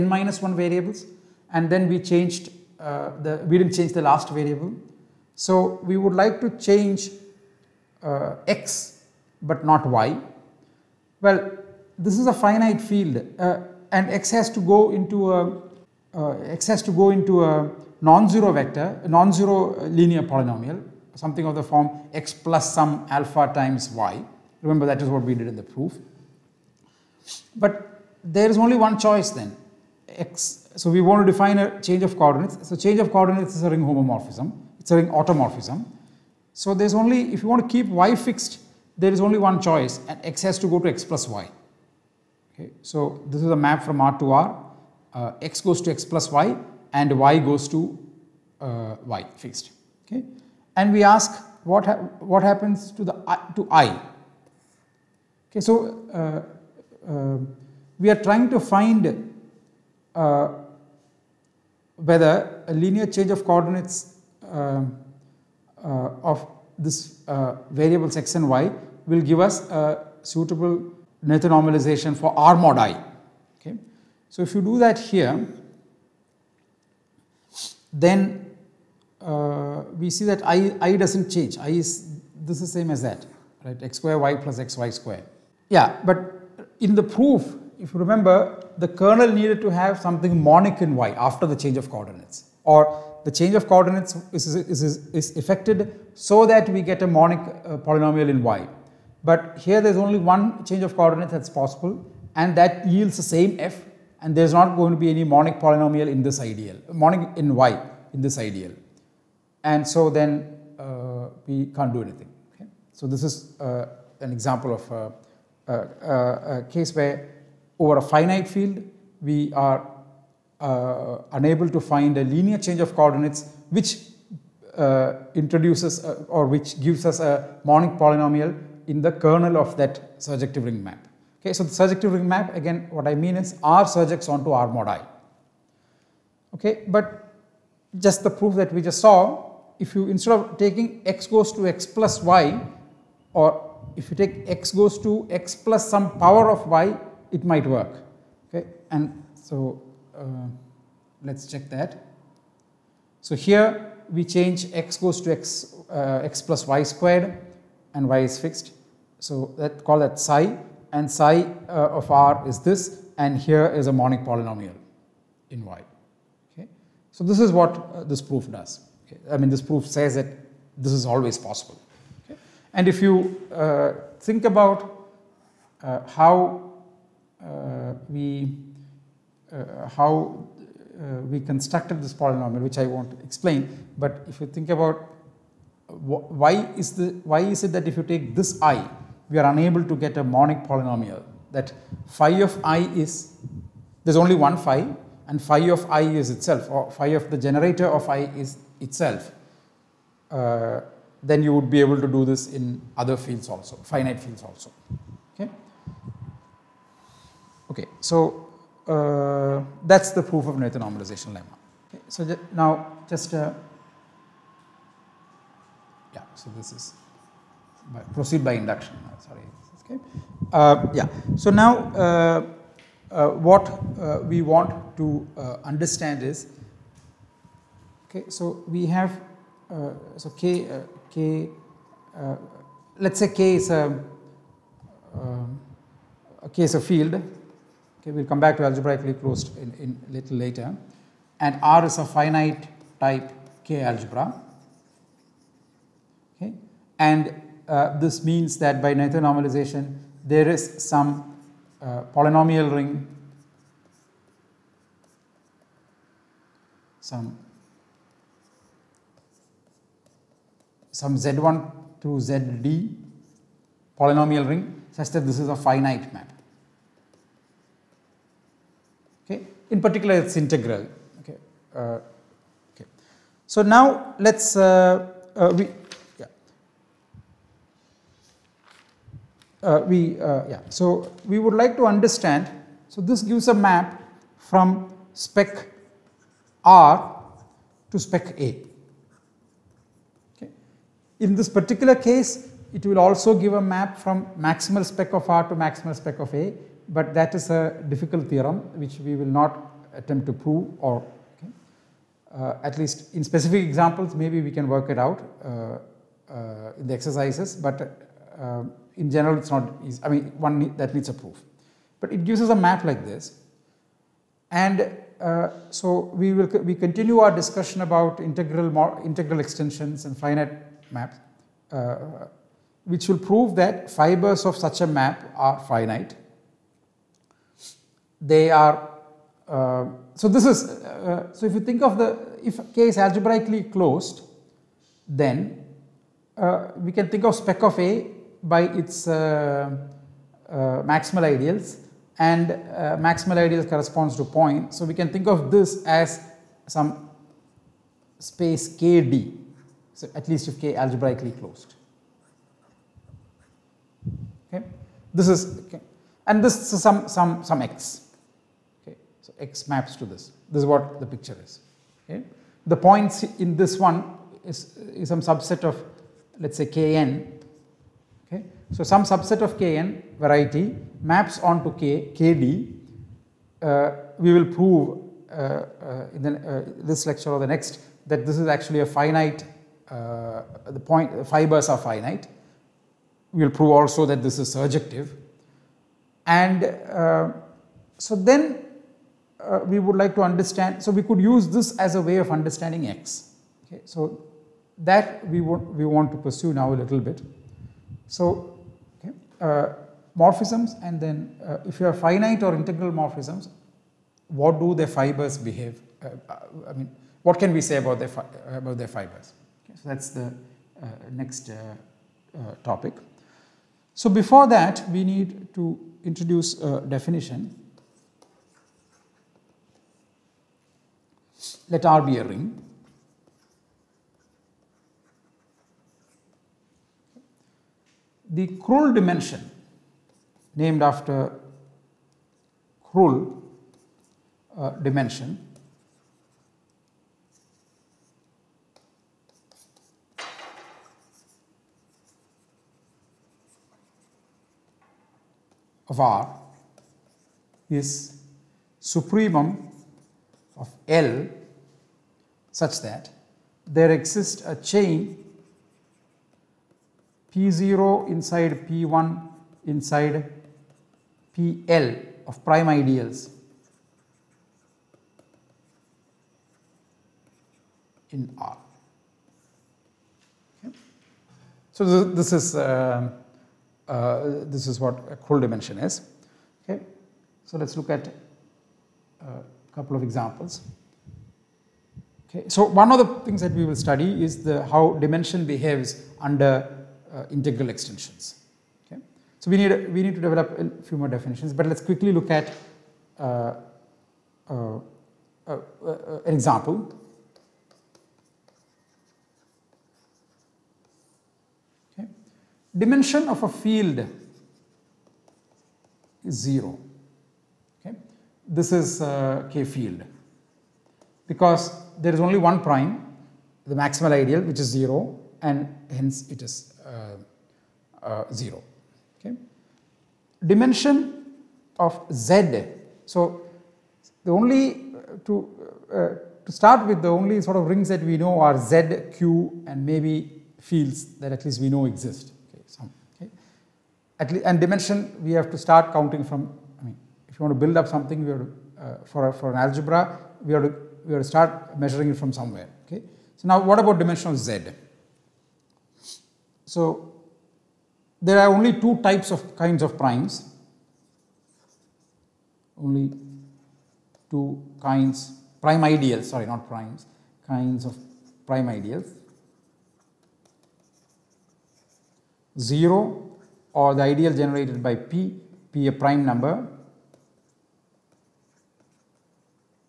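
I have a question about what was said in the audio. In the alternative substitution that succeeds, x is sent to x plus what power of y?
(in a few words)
y squared.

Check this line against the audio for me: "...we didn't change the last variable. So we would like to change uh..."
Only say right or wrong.
right.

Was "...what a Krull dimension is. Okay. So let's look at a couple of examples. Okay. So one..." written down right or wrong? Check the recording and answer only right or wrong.
right.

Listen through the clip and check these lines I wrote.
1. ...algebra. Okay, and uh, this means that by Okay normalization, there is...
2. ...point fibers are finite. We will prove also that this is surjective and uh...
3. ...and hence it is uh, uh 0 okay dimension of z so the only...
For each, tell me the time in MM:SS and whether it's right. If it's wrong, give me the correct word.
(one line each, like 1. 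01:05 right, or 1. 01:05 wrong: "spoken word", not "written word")
1. 04:03 wrong: "Noether", not "Okay"
2. 06:20 right
3. 08:35 right.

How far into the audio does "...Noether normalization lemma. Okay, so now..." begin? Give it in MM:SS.
03:30.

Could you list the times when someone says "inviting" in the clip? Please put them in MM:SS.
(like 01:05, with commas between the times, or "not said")
not said.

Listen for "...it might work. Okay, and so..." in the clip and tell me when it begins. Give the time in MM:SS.
02:27.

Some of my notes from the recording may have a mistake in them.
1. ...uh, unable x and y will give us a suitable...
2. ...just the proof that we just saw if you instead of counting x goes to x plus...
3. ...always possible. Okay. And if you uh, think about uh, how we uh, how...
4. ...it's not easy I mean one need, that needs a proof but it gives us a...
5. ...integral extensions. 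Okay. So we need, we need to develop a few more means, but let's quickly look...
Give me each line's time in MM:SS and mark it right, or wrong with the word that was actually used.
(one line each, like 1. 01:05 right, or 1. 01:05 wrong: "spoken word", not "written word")
1. 01:07 wrong: "variable", not "unable"
2. 02:17 wrong: "taking", not "counting"
3. 02:51 right
4. 05:09 right
5. 08:07 wrong: "definitions", not "means".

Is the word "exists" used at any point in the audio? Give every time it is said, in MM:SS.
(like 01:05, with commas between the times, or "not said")
07:33, 08:51.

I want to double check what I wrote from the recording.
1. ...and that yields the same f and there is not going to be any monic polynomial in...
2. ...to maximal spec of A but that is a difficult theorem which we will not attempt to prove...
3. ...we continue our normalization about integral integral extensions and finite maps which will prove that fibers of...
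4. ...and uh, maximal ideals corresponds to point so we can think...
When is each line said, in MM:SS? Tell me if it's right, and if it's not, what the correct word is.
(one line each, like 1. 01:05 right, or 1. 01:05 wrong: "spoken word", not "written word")
1. 01:42 right
2. 04:55 right
3. 05:16 wrong: "discussion", not "normalization"
4. 05:42 right.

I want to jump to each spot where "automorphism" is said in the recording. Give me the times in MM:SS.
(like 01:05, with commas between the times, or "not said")
00:35.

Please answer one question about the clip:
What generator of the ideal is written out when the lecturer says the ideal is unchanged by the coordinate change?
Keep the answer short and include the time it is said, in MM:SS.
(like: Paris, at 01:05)
x^2 y + x y^2, at 01:23.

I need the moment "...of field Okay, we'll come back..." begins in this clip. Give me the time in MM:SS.
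03:56.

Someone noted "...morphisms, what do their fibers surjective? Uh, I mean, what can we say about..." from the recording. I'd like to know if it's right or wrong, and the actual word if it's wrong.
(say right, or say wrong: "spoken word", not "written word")
wrong: "behave", not "surjective".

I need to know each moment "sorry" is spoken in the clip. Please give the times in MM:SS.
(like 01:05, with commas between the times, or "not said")
03:39, 09:16.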